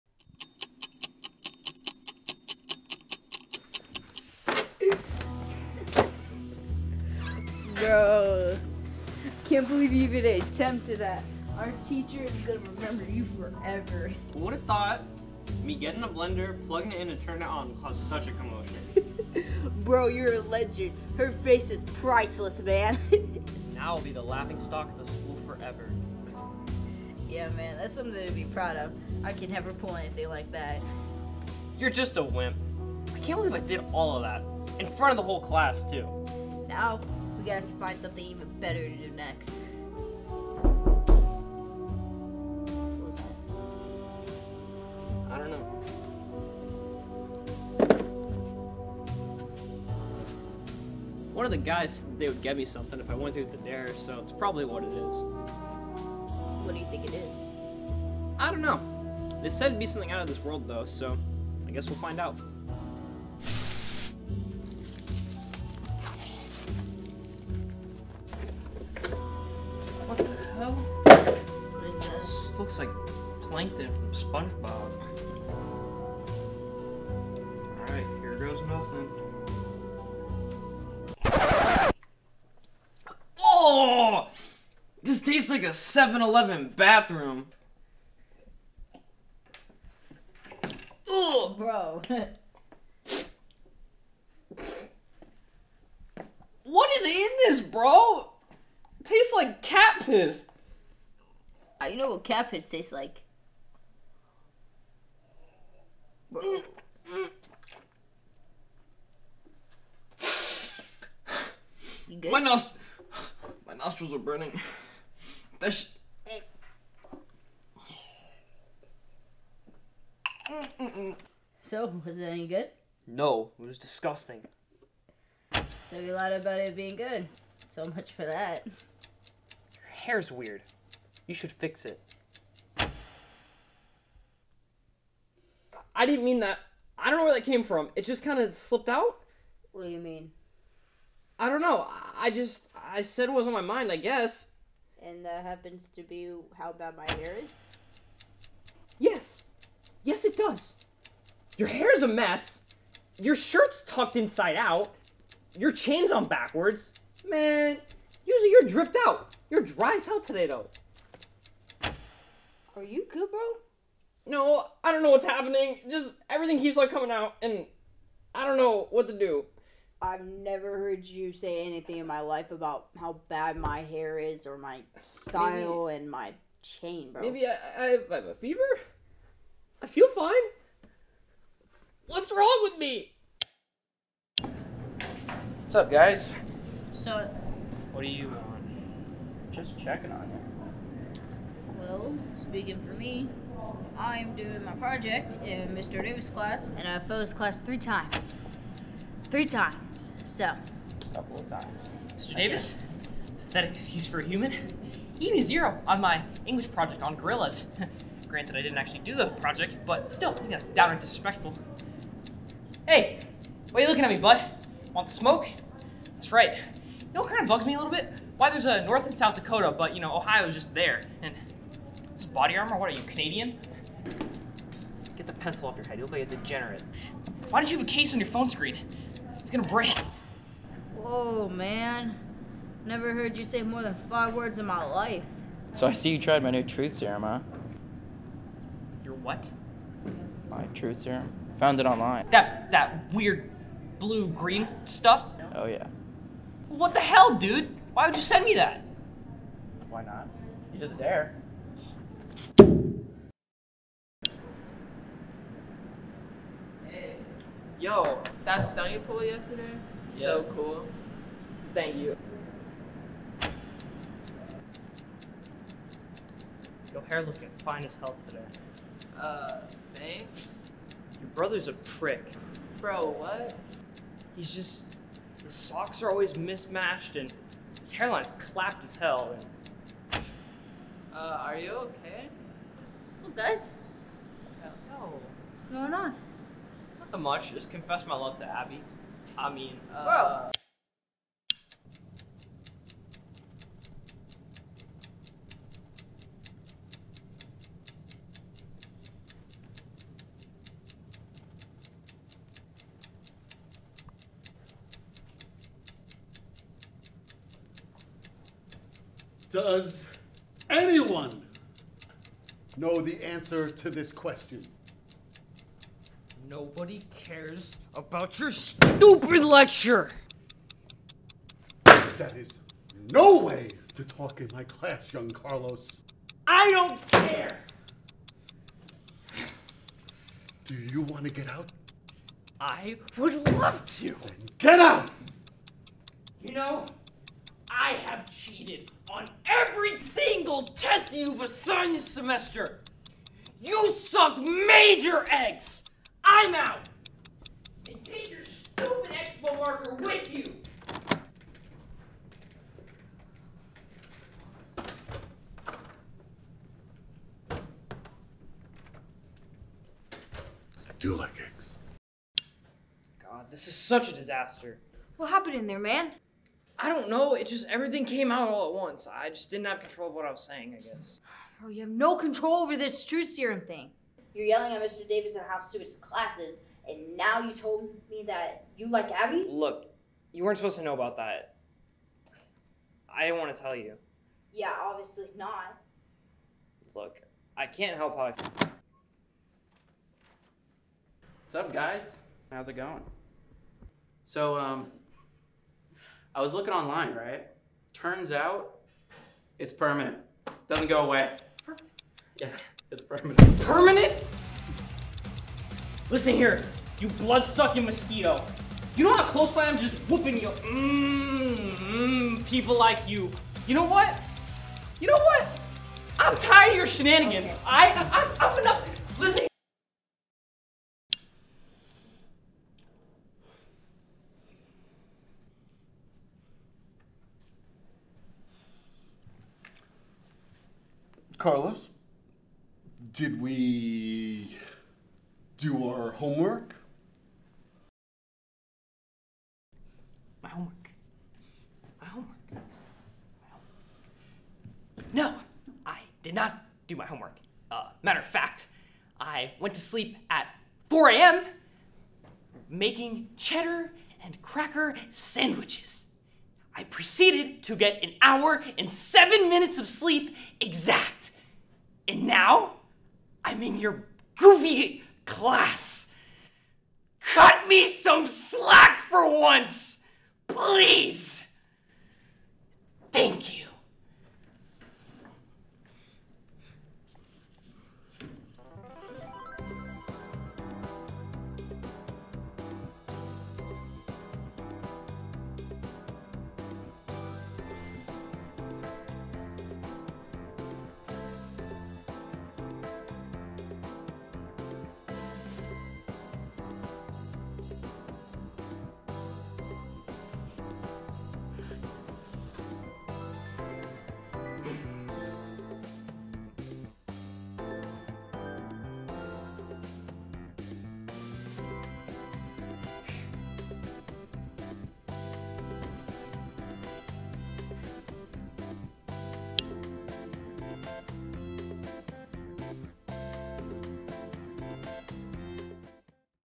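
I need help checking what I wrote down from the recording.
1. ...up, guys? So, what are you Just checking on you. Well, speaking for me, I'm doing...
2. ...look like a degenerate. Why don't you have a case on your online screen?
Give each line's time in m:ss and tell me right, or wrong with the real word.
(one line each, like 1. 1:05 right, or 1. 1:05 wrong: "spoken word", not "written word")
1. 3:05 right
2. 3:46 wrong: "phone", not "online".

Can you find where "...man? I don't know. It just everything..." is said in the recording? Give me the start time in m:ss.
6:05.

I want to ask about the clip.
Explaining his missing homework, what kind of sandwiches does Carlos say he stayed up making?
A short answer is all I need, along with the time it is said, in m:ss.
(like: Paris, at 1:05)
Cheddar and cracker sandwiches, at 7:33.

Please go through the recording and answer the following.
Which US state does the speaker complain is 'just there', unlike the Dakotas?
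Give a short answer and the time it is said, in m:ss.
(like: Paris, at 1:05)
Ohio, at 3:40.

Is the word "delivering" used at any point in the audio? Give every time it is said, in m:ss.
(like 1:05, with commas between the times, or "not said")
not said.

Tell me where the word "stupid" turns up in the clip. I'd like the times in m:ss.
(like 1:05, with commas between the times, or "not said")
5:18, 5:48, 6:15.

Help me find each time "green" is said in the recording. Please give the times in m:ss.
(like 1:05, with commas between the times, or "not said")
4:04.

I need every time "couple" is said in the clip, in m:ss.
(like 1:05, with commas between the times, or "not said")
3:21.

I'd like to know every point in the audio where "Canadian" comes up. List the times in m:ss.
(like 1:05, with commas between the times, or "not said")
3:43.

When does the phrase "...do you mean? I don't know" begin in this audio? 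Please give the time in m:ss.
2:19.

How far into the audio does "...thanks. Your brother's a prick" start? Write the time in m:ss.
4:29.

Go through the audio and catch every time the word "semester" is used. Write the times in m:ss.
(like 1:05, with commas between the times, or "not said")
5:42.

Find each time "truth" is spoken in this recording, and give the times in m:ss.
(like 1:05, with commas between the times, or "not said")
3:56, 4:00, 6:13.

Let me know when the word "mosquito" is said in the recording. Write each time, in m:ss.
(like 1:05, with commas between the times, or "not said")
6:47.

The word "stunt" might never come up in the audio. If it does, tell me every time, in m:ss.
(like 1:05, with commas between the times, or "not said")
4:18.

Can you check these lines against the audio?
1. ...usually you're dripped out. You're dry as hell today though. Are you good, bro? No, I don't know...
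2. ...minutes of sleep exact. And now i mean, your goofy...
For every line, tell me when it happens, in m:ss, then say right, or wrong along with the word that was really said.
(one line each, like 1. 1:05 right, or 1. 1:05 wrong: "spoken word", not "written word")
1. 2:38 right
2. 7:39 right.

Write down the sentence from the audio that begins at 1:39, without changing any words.
Tastes like cat piss you know what cabbage tastes like.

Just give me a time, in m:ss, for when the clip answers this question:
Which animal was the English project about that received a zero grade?
3:27.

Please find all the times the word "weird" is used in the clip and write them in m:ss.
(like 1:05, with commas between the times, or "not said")
2:10, 4:03.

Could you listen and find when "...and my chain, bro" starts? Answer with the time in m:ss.
2:55.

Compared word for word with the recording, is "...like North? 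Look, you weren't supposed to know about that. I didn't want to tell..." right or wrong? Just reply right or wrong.
wrong.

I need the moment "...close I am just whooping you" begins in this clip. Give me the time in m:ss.
6:49.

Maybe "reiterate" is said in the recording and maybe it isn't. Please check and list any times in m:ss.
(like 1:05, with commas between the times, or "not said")
not said.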